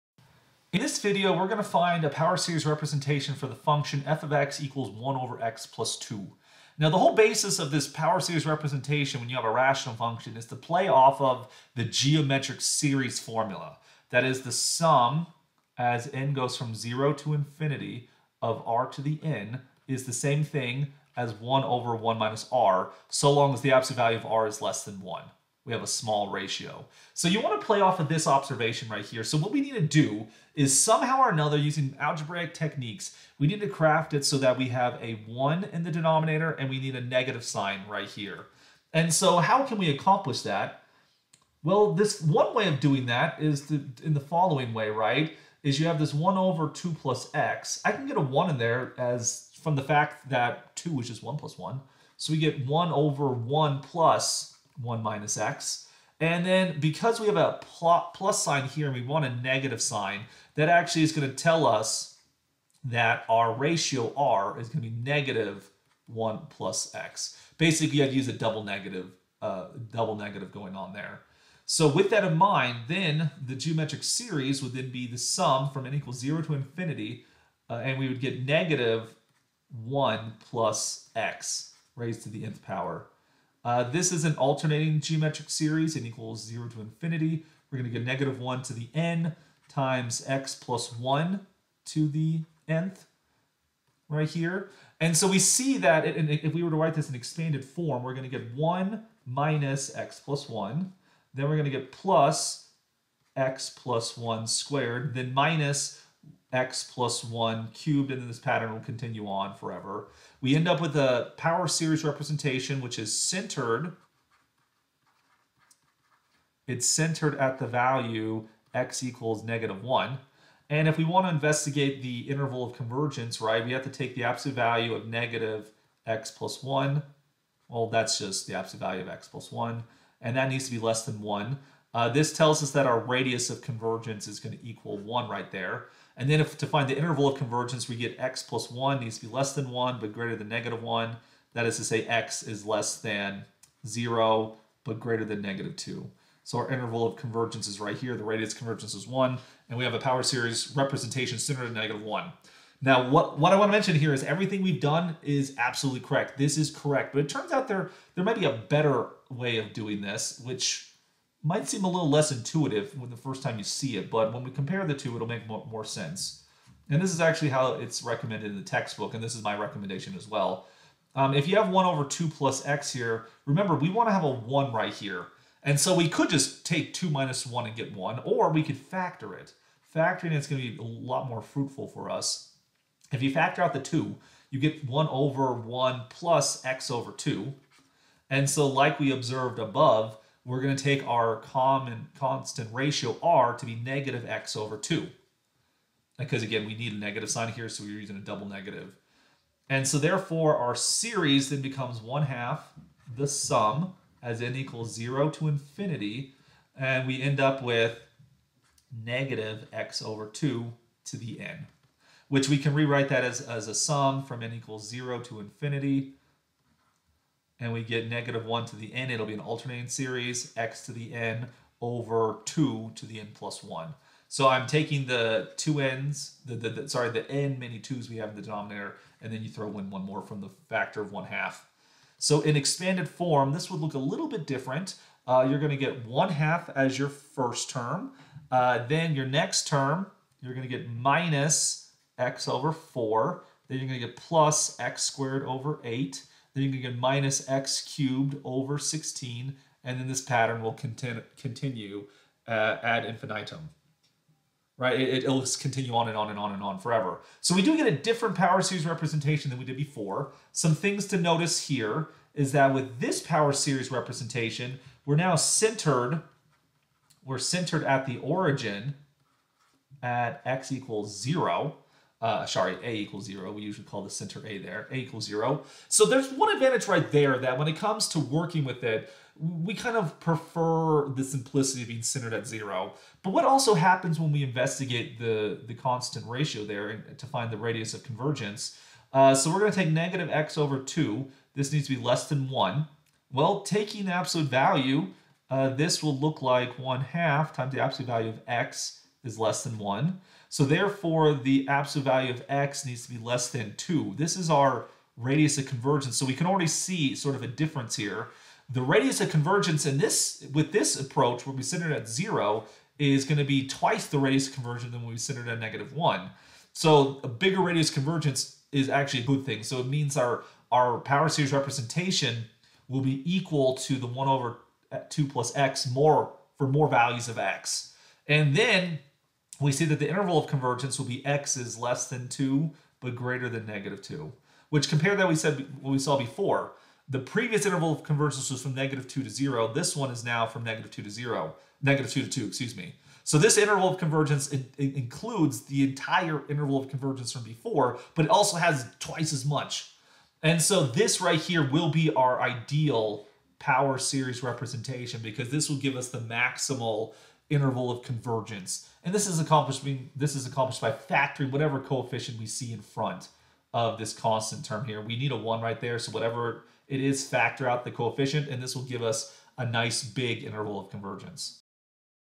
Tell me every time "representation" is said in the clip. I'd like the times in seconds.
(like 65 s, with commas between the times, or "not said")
2 s, 8 s, 112 s, 150 s, 258 s, 263 s, 321 s, 354 s.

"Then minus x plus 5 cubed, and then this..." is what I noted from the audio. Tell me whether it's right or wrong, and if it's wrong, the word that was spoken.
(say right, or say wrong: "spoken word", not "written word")
wrong: "1", not "5".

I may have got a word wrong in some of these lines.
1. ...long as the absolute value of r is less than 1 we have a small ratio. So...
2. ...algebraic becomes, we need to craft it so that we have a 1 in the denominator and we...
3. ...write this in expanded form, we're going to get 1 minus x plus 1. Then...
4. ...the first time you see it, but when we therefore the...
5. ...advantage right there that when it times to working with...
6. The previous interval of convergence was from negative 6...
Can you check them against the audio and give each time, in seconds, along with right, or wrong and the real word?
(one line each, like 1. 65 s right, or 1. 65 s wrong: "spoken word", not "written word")
1. 23 s right
2. 31 s wrong: "techniques", not "becomes"
3. 96 s right
4. 163 s wrong: "compare", not "therefore"
5. 276 s wrong: "comes", not "times"
6. 337 s wrong: "2", not "6".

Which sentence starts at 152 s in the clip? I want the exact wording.
Now, what, what I want to mention here is everything we've done is absolutely correct.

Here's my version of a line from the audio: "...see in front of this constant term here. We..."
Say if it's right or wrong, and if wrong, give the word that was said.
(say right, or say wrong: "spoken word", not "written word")
right.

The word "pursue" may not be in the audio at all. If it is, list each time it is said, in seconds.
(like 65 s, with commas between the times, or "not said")
not said.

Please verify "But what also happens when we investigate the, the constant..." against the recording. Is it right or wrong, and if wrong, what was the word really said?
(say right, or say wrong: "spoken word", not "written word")
right.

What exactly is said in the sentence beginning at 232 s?
So in expanded form, this would look a little bit different.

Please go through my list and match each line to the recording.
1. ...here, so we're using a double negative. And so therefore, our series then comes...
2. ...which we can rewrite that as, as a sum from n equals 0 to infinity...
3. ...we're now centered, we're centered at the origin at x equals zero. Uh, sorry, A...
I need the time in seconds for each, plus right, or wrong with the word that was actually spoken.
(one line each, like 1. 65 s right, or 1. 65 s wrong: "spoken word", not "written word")
1. 197 s wrong: "becomes", not "comes"
2. 212 s right
3. 265 s right.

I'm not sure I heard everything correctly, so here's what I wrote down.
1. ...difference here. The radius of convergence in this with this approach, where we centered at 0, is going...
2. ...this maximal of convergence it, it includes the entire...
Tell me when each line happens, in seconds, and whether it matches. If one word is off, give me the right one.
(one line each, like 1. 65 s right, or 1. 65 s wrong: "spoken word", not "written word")
1. 307 s right
2. 343 s wrong: "interval", not "maximal".